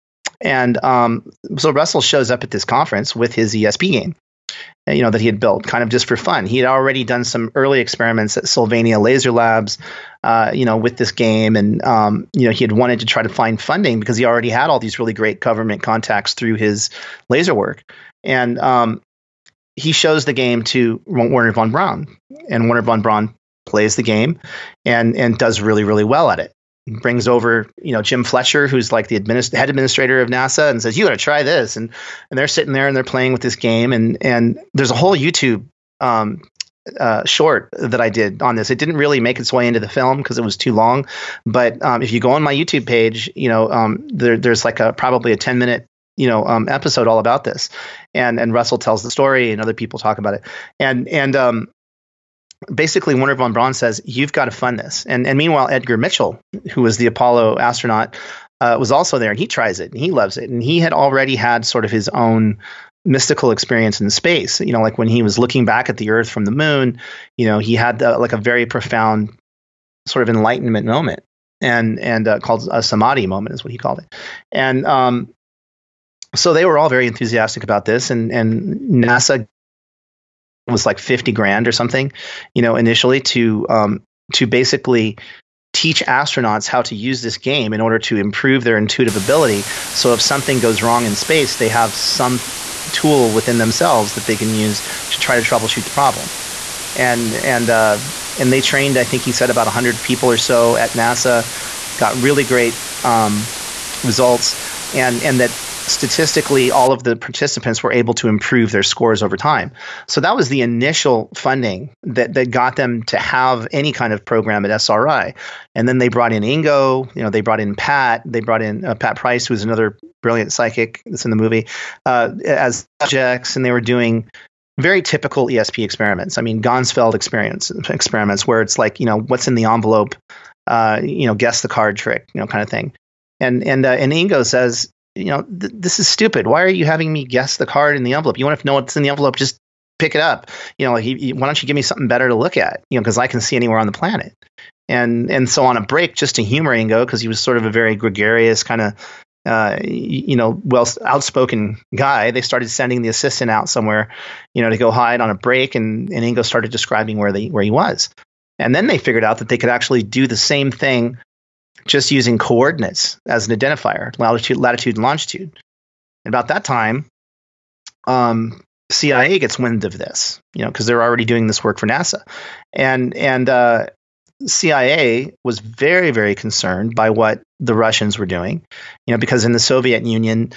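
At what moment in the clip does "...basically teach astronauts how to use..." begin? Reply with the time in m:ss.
1:24.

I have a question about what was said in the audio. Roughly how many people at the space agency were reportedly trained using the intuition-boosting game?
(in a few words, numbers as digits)
100.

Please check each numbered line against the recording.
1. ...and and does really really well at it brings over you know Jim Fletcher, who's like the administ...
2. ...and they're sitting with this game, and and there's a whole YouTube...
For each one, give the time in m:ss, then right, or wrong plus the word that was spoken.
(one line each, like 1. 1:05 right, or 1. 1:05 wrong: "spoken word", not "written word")
1. 0:24 right
2. 0:32 wrong: "playing", not "sitting".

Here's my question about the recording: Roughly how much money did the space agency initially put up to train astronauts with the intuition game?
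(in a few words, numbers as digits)
50 grand.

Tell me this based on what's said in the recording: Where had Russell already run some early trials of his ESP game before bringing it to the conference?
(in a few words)
Sylvania laser labs.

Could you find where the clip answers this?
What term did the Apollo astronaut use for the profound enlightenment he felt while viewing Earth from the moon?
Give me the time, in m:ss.
1:12.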